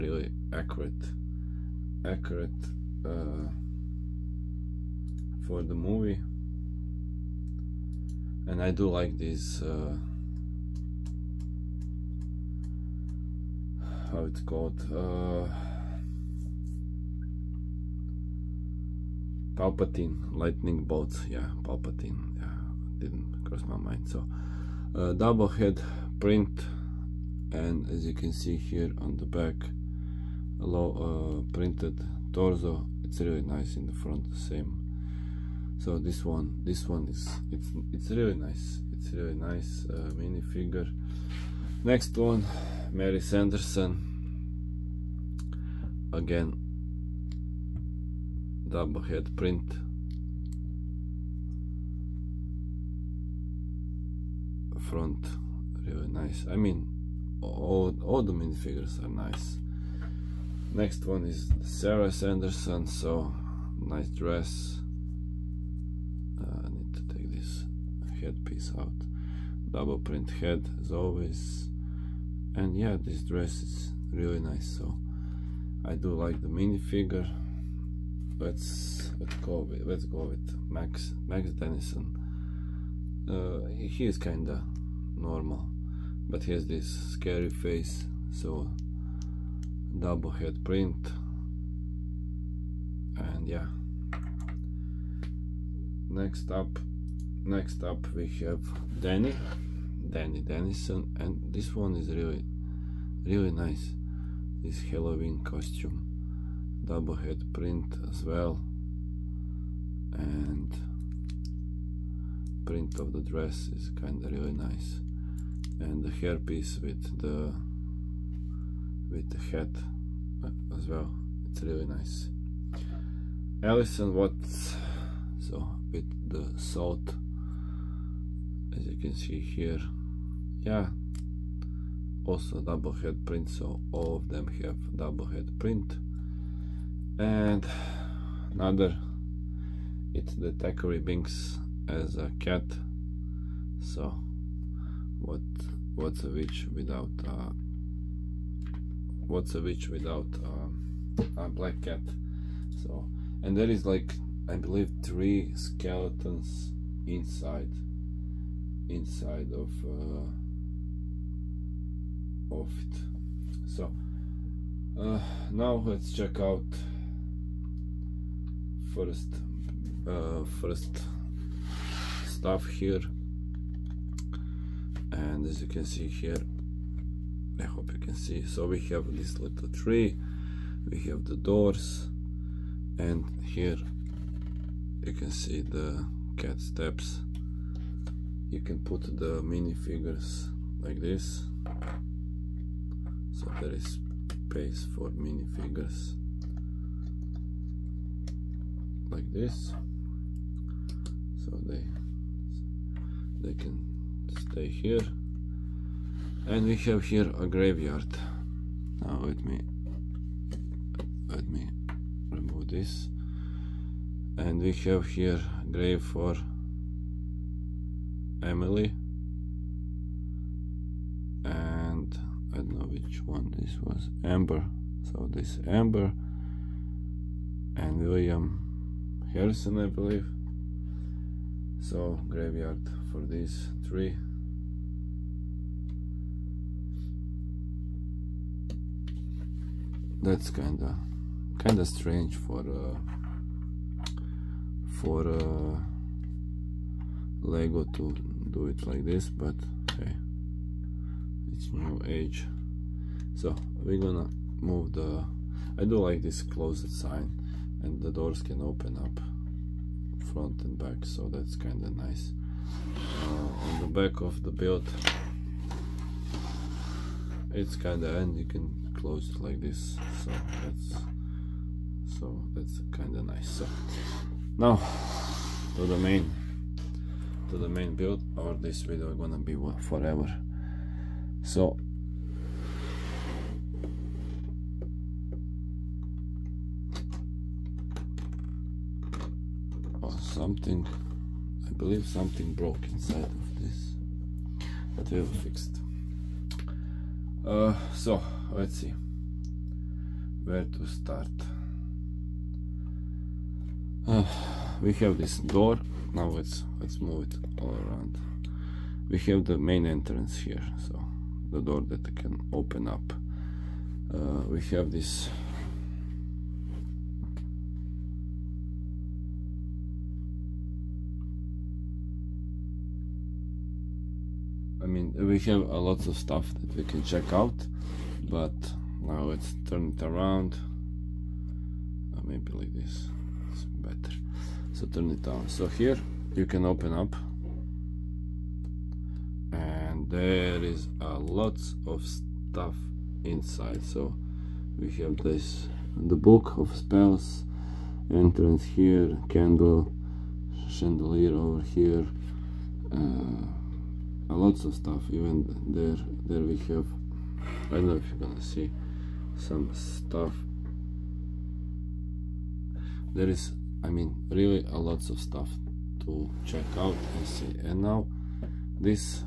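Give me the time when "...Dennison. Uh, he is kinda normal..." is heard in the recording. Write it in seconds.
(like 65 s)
81 s.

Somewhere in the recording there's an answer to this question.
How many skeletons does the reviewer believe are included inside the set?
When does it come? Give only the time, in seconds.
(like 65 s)
155 s.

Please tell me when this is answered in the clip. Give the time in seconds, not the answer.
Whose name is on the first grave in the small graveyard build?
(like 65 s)
218 s.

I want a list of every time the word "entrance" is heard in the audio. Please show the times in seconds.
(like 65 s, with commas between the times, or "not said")
309 s, 348 s.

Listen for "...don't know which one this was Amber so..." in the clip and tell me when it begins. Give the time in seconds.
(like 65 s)
222 s.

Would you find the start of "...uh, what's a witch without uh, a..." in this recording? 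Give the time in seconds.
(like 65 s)
147 s.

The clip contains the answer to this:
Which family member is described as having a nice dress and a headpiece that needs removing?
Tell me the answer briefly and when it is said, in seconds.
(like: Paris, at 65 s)
Sarah Sanderson, at 61 s.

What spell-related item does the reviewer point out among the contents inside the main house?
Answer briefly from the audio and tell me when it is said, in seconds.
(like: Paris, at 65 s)
The book of spells, at 346 s.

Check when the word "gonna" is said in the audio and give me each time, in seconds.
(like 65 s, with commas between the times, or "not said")
253 s, 279 s, 358 s.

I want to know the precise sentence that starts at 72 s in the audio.
And yeah, this dress is really nice, so I do like the minifigure.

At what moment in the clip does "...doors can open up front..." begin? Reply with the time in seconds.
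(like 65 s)
258 s.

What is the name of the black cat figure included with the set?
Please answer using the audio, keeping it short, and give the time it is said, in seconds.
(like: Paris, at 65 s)
Thackery Binx, at 140 s.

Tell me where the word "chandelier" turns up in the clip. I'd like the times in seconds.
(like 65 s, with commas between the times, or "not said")
350 s.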